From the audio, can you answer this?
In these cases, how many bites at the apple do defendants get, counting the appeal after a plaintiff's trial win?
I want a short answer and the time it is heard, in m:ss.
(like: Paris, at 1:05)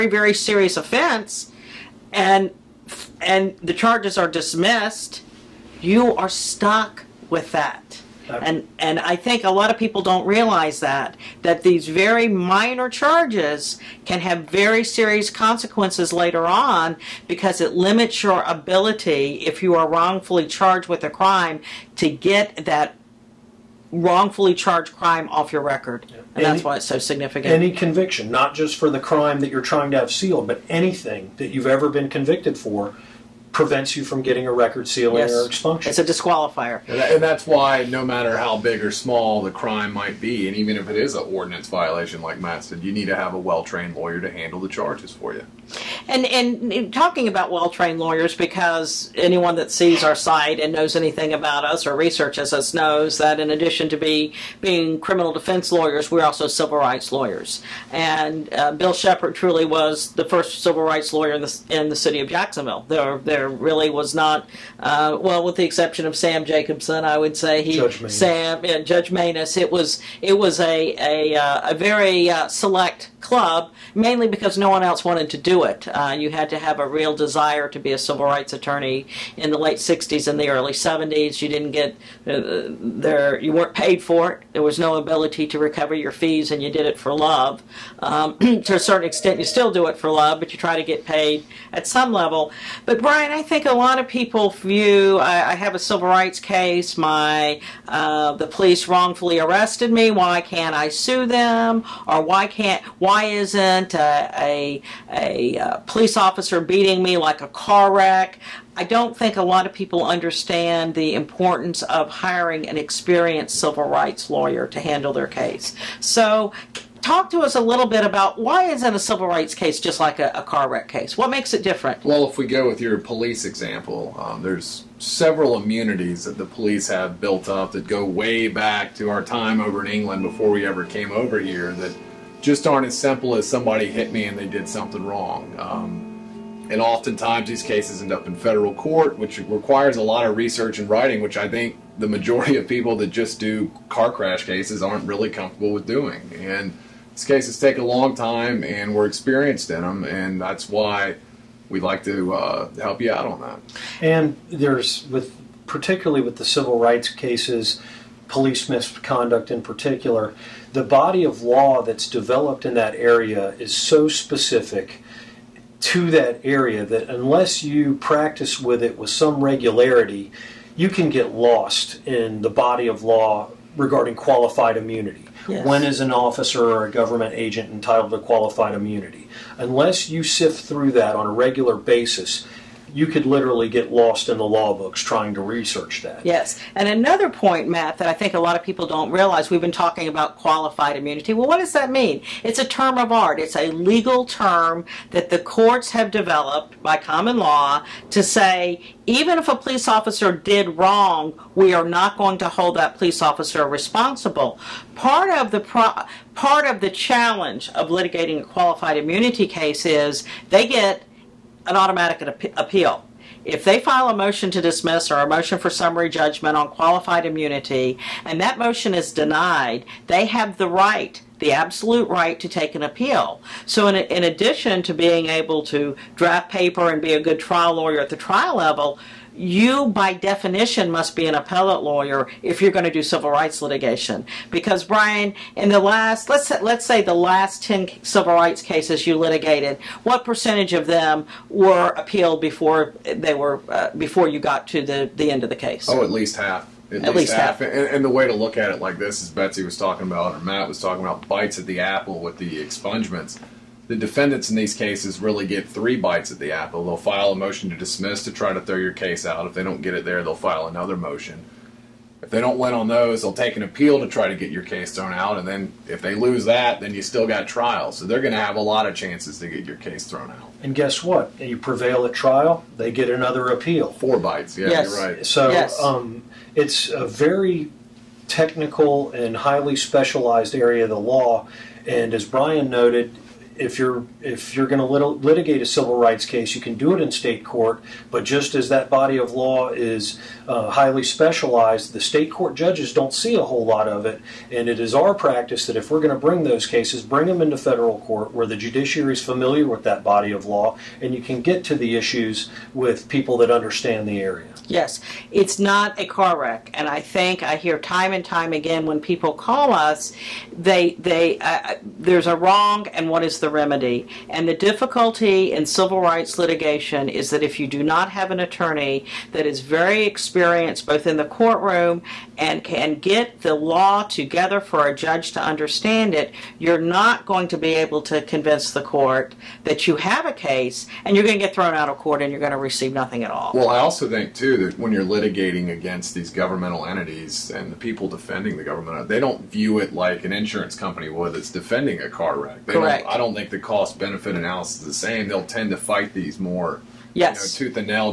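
4, at 4:33.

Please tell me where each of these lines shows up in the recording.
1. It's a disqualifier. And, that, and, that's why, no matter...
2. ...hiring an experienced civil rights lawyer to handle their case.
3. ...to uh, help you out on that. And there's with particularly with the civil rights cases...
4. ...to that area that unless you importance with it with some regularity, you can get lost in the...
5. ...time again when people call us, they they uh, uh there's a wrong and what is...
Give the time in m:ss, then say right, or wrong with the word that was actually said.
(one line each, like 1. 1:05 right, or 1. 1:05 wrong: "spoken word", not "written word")
1. 0:35 right
2. 1:52 right
3. 2:32 right
4. 2:45 wrong: "practice", not "importance"
5. 5:08 right.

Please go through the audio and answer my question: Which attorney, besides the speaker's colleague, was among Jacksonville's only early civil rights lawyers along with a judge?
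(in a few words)
Sam Jacobson.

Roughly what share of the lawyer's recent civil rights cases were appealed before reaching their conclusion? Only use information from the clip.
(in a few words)
At least half.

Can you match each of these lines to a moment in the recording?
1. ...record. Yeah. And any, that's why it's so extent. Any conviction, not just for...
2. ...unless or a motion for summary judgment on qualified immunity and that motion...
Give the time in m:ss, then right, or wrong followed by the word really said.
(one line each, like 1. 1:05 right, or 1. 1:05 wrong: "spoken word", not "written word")
1. 0:25 wrong: "significant", not "extent"
2. 3:34 wrong: "dismiss", not "unless".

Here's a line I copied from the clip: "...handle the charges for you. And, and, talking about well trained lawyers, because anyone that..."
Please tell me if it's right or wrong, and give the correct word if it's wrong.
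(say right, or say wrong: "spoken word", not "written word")
right.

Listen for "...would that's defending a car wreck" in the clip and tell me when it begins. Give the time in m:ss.
5:41.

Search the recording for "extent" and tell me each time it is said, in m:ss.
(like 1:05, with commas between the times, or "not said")
1:29.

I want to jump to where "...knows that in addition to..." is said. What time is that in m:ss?
0:52.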